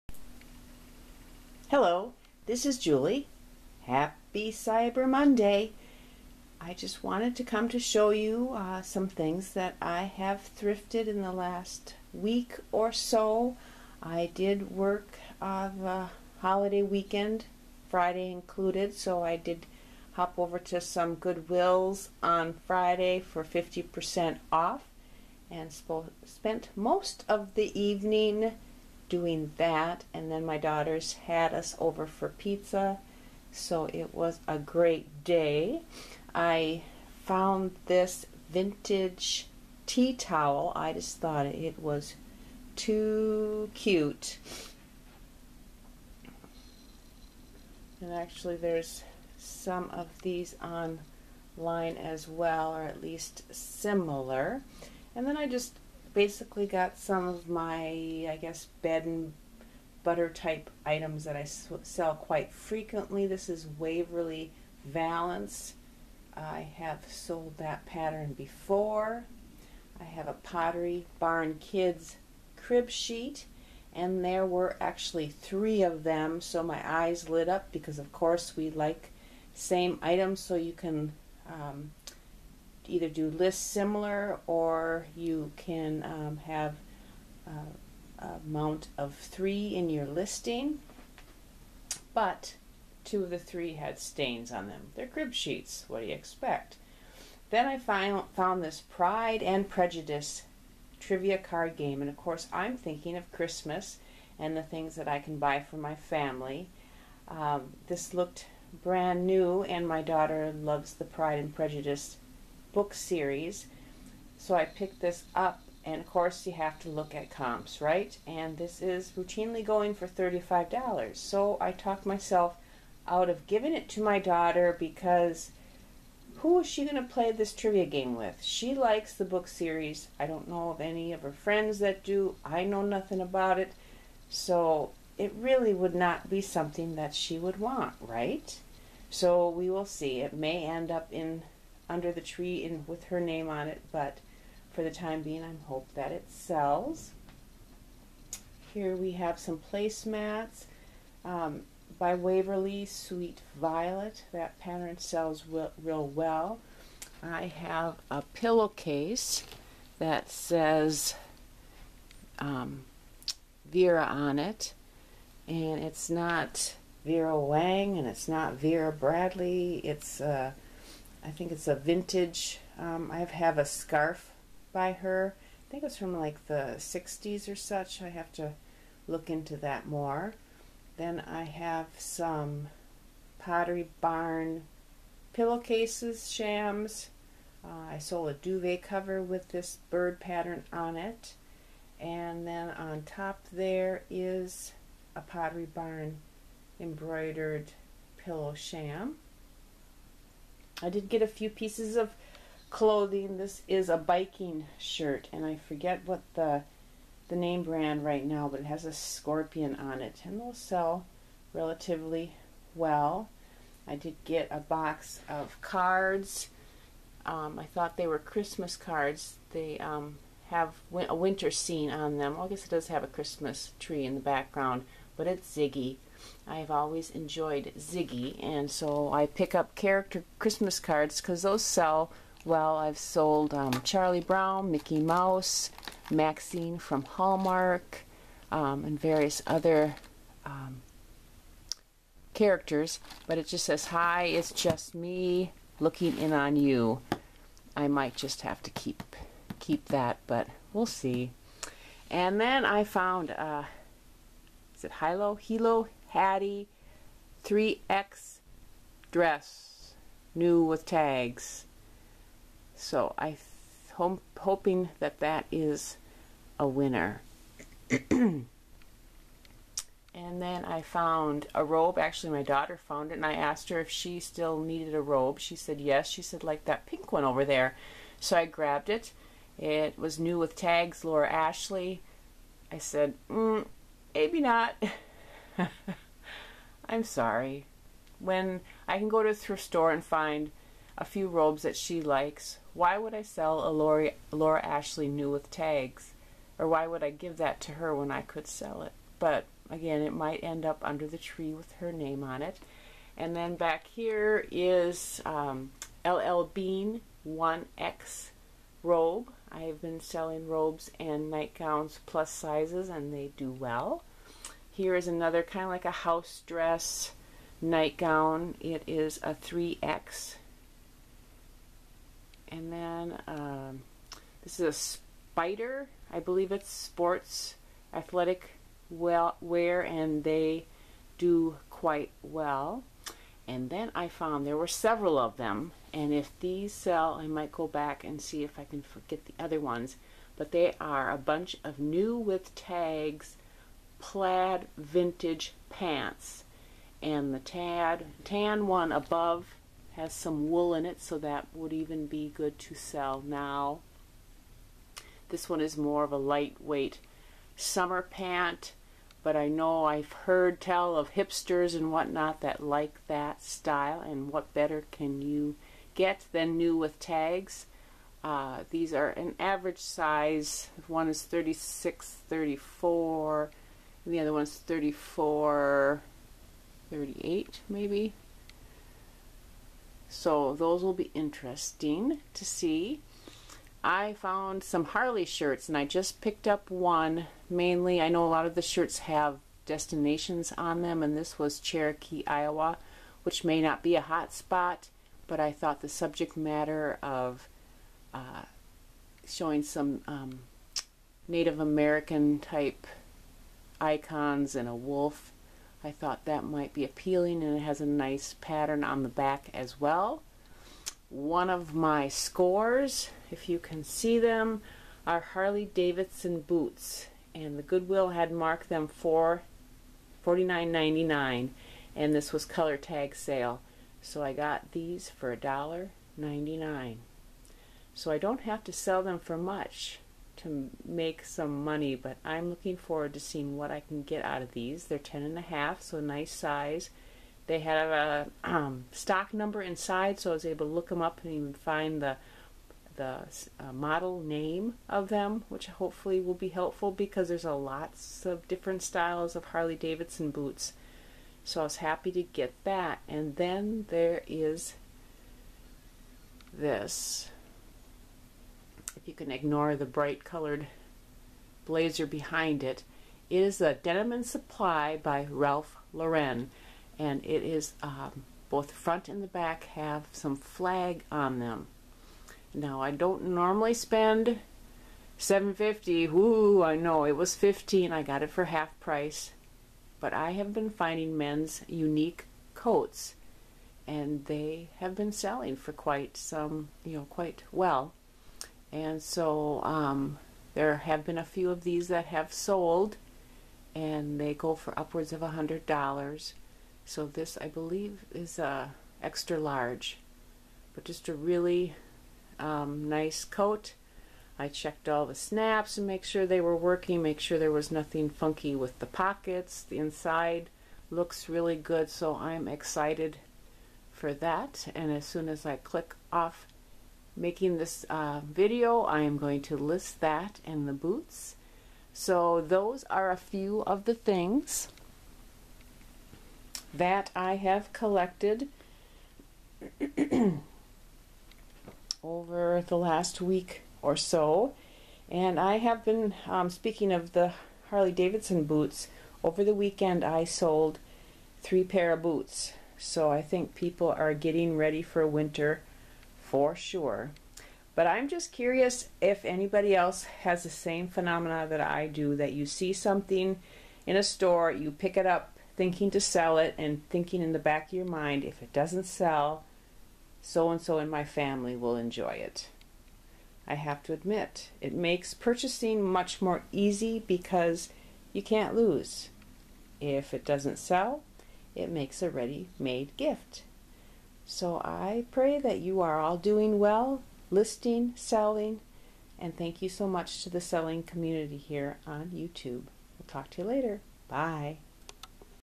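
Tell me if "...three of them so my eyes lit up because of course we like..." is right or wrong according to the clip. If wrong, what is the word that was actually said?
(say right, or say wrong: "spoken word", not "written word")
right.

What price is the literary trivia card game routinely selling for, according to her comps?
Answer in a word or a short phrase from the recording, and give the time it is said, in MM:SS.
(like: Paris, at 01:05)
$35, at 02:00.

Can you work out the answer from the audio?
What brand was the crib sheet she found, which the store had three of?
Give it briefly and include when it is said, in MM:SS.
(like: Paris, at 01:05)
Pottery Barn Kids, at 01:10.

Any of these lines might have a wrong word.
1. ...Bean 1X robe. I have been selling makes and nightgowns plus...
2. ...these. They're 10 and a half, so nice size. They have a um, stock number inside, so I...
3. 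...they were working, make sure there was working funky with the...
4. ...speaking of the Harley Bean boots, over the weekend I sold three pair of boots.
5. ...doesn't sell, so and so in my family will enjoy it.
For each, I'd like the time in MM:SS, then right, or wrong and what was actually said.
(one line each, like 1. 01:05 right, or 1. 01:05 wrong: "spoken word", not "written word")
1. 05:06 wrong: "robes", not "makes"
2. 07:14 right
3. 08:26 wrong: "nothing", not "working"
4. 08:56 wrong: "Davidson", not "Bean"
5. 09:18 right.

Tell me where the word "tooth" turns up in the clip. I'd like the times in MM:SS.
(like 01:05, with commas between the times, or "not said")
not said.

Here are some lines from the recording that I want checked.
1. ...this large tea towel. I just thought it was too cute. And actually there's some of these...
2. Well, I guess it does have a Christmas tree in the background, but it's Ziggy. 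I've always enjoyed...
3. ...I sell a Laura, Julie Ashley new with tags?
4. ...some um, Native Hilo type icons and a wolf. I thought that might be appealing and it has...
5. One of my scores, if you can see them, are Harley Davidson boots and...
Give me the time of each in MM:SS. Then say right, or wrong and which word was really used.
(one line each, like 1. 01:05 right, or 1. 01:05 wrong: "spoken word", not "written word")
1. 00:37 wrong: "vintage", not "large"
2. 03:42 right
3. 04:53 wrong: "Laura", not "Julie"
4. 06:39 wrong: "American", not "Hilo"
5. 06:51 right.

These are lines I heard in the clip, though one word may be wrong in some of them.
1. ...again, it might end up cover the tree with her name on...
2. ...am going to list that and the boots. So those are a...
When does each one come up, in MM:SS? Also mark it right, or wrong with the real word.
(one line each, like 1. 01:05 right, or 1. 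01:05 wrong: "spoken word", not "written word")
1. 04:59 wrong: "under", not "cover"
2. 08:39 right.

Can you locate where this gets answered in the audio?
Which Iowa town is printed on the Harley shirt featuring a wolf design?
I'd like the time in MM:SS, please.
06:31.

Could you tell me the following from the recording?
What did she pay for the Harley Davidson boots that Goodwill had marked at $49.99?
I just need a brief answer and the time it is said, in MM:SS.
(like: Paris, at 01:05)
$1.99, at 07:05.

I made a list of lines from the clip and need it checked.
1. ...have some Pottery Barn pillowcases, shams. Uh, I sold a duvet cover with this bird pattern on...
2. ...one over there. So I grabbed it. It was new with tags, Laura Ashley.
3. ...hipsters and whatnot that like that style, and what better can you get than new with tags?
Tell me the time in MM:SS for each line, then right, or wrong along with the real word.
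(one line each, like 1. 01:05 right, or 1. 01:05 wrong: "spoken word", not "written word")
1. 03:01 right
2. 04:37 right
3. 06:01 right.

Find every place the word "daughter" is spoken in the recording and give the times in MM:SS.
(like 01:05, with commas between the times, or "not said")
00:30, 01:50, 02:04, 04:32.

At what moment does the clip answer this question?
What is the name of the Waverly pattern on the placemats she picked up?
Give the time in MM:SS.
02:32.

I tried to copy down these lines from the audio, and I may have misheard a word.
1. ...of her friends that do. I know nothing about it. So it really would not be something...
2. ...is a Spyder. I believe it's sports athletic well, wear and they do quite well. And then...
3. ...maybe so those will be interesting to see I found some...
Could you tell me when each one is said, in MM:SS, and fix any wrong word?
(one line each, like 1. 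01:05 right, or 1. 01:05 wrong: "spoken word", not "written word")
1. 02:11 right
2. 05:24 right
3. 06:17 right.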